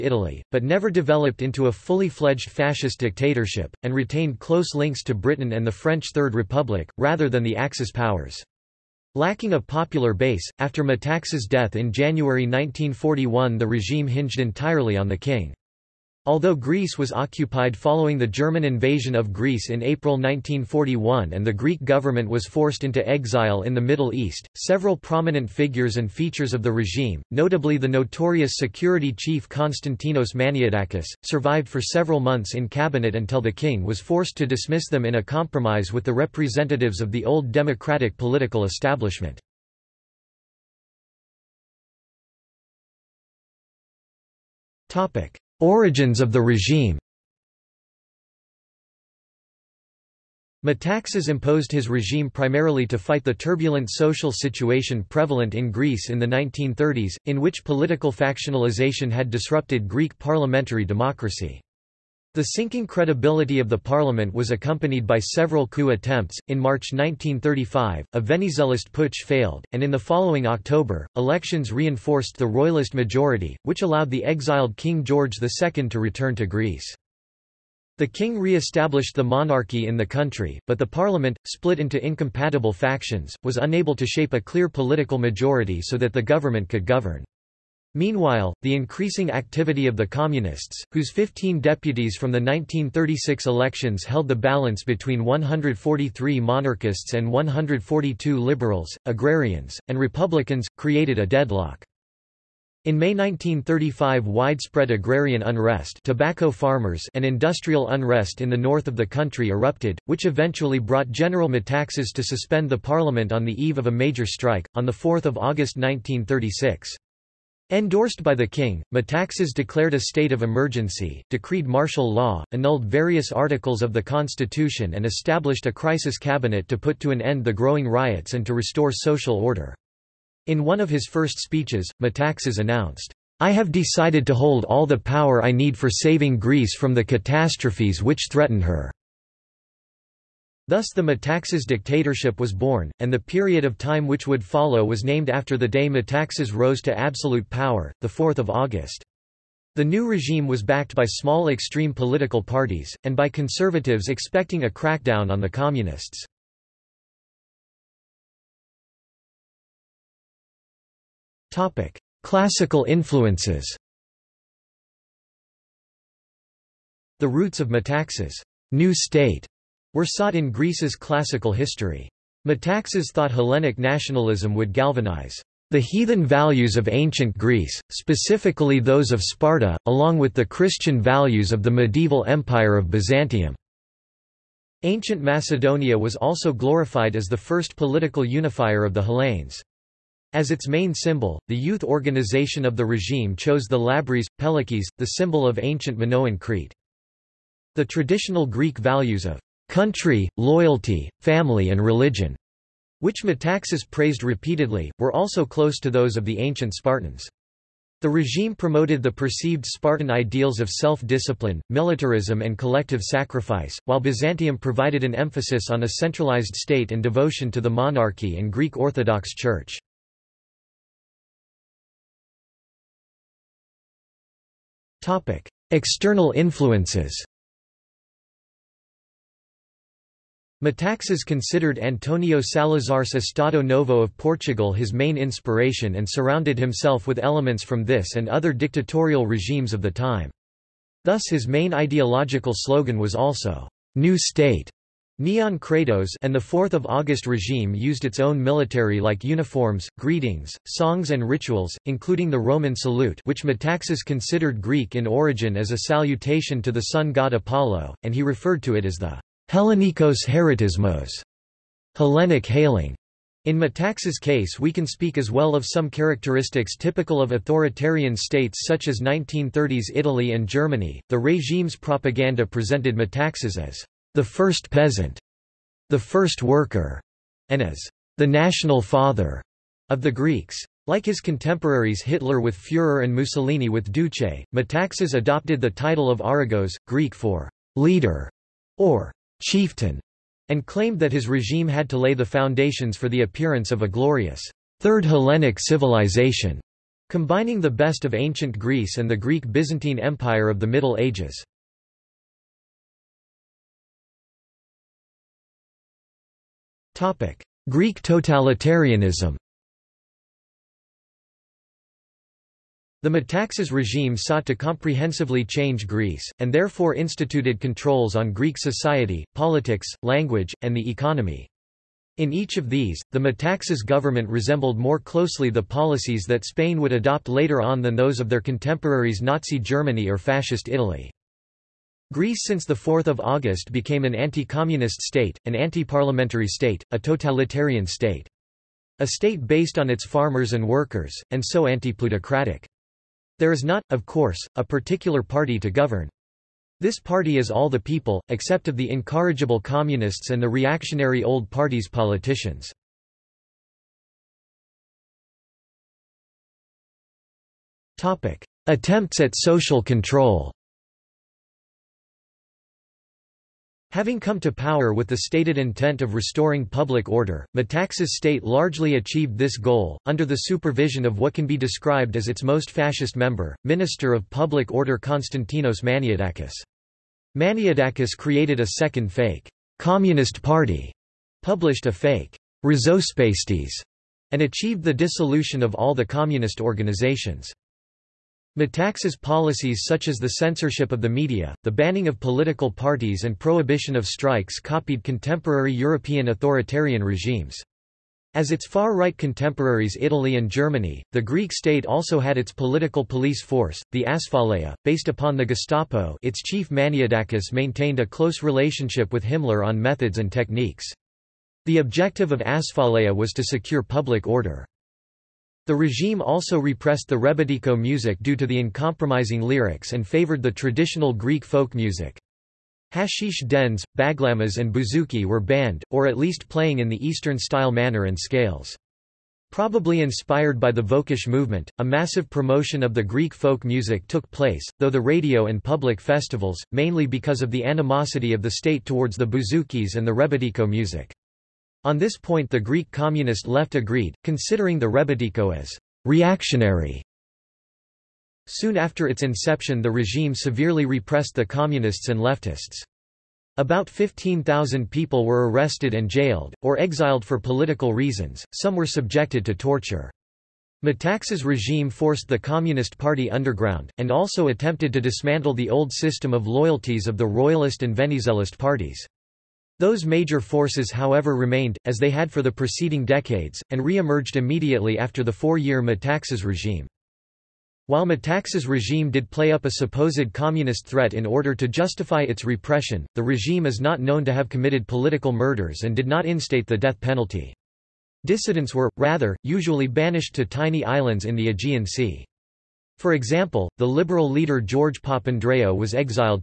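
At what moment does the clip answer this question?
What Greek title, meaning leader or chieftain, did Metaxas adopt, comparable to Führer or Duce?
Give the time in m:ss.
4:46.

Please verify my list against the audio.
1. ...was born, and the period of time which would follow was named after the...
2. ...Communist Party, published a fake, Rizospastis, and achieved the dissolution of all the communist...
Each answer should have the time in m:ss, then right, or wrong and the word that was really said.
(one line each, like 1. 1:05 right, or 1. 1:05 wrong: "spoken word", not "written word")
1. 2:22 right
2. 6:19 right.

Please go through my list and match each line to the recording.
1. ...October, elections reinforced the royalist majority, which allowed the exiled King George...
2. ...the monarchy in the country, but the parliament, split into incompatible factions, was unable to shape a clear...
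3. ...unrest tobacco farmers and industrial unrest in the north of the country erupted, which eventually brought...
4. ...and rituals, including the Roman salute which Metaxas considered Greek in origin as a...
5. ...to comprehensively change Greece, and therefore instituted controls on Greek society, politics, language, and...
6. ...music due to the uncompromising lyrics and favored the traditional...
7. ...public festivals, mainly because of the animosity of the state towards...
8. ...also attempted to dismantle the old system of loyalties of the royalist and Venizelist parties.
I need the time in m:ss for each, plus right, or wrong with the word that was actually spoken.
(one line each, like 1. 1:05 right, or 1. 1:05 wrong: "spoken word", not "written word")
1. 1:10 right
2. 1:19 right
3. 1:45 right
4. 4:11 right
5. 5:14 right
6. 6:57 right
7. 7:15 right
8. 7:44 right.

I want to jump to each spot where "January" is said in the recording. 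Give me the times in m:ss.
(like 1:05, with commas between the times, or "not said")
0:11.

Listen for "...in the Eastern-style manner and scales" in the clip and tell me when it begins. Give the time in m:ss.
7:06.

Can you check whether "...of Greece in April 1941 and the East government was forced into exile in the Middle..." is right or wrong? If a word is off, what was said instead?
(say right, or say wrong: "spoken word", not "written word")
wrong: "Greek", not "East".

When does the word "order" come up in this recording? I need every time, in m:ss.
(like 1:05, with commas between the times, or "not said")
2:09, 6:07, 6:14, 6:54, 8:01.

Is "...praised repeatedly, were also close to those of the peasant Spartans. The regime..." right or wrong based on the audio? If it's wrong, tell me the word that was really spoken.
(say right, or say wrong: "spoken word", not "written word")
wrong: "ancient", not "peasant".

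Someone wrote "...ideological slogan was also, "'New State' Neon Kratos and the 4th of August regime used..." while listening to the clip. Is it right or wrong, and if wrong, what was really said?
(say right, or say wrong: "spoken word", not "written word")
right.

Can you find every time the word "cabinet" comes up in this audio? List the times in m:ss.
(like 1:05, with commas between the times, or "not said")
0:32, 2:06.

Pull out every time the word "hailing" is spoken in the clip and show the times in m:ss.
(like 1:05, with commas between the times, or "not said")
4:22.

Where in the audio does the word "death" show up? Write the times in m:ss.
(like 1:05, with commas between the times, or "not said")
0:11, 8:06.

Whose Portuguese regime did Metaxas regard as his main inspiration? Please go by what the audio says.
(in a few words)
Antonio Salazar.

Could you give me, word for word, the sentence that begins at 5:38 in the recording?
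A state based on its farmers and workers, and so anti-plutocratic.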